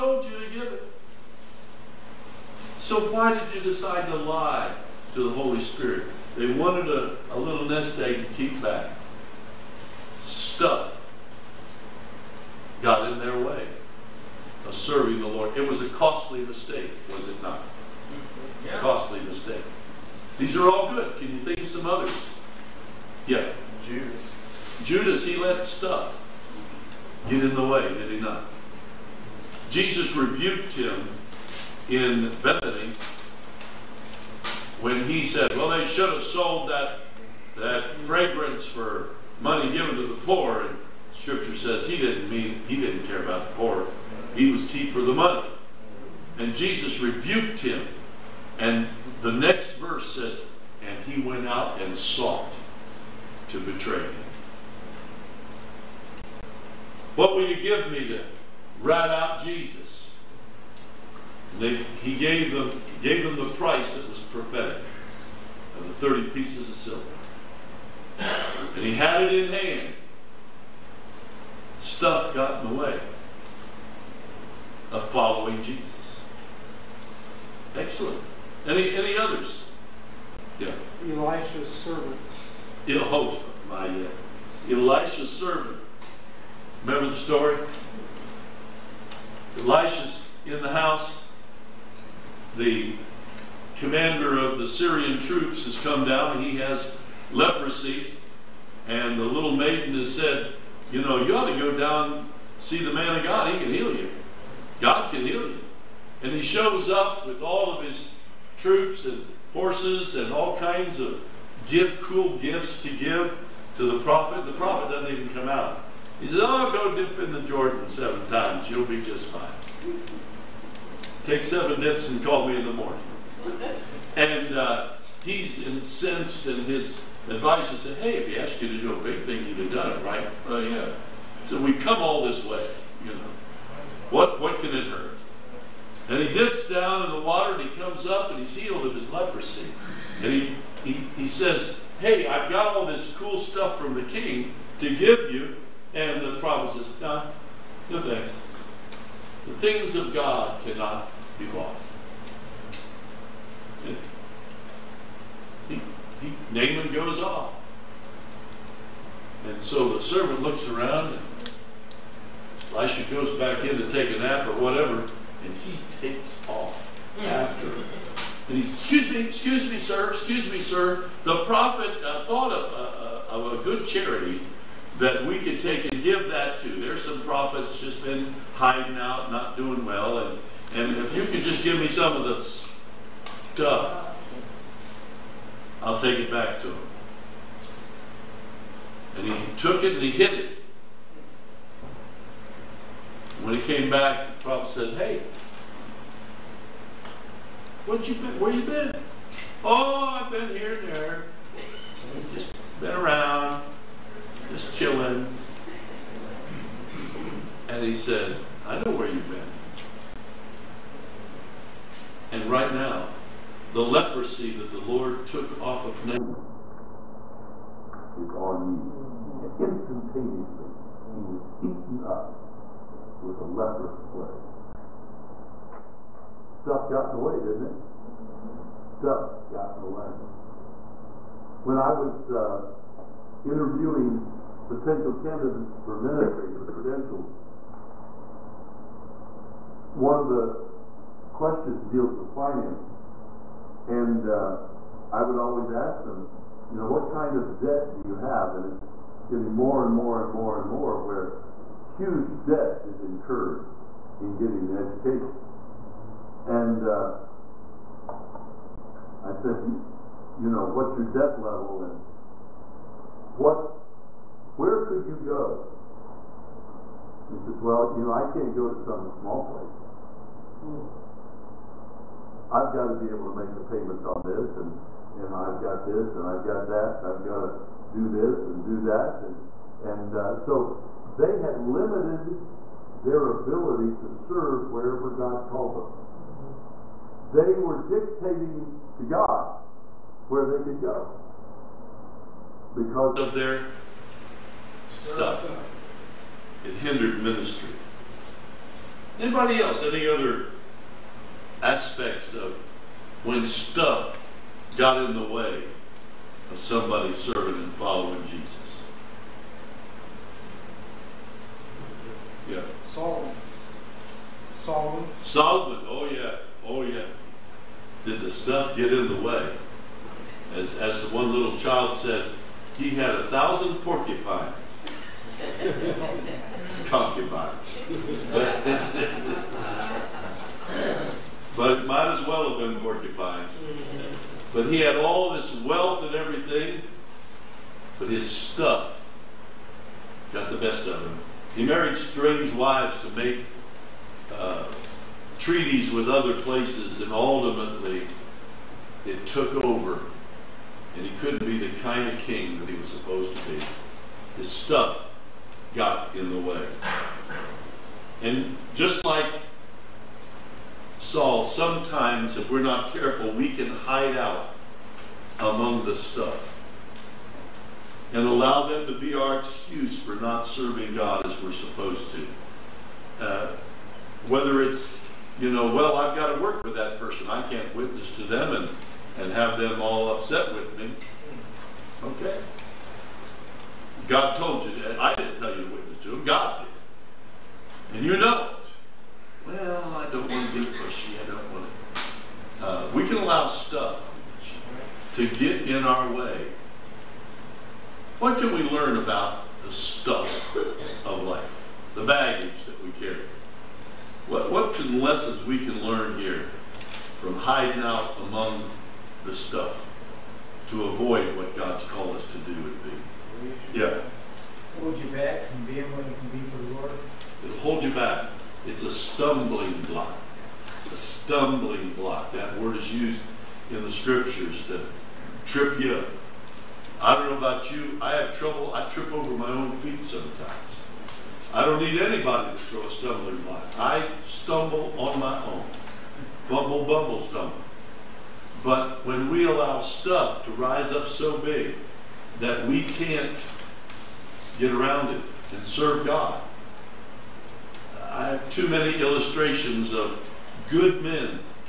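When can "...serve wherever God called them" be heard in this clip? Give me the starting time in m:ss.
4:44.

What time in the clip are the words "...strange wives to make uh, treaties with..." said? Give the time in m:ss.
5:41.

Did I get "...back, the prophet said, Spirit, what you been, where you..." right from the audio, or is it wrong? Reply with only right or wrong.
wrong.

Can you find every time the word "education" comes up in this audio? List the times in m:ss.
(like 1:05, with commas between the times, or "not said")
4:14.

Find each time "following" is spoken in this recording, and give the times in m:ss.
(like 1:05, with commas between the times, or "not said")
1:15, 5:07.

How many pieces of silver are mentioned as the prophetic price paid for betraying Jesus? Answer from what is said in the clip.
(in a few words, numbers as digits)
30.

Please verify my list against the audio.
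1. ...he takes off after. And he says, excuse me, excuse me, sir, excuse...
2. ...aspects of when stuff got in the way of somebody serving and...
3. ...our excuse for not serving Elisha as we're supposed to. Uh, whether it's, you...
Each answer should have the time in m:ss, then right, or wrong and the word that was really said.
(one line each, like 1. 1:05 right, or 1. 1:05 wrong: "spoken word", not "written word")
1. 2:45 right
2. 5:01 right
3. 6:09 wrong: "God", not "Elisha".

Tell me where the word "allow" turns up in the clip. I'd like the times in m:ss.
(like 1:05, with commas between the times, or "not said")
6:08, 6:33, 7:19.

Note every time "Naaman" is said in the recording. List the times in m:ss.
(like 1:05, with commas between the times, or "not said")
2:36, 3:36.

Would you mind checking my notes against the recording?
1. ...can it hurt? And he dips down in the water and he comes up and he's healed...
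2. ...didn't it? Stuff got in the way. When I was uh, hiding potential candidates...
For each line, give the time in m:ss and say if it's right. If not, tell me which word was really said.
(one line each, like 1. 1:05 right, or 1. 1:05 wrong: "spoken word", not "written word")
1. 2:14 right
2. 3:47 wrong: "interviewing", not "hiding".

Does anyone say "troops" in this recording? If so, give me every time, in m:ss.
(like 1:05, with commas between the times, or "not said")
1:35, 1:48.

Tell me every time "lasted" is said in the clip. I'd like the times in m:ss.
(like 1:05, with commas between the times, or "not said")
not said.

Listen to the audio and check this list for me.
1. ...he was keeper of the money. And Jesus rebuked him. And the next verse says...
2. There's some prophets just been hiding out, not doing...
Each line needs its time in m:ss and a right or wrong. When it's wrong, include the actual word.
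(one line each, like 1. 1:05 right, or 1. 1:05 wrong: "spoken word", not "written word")
1. 0:44 right
2. 2:56 right.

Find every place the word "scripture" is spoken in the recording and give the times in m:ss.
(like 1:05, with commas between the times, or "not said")
0:41, 7:03.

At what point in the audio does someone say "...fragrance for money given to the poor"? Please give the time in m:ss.
0:38.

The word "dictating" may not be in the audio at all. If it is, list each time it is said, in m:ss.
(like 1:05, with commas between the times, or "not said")
4:47.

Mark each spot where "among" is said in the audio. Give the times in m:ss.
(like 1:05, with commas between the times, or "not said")
6:05, 6:48.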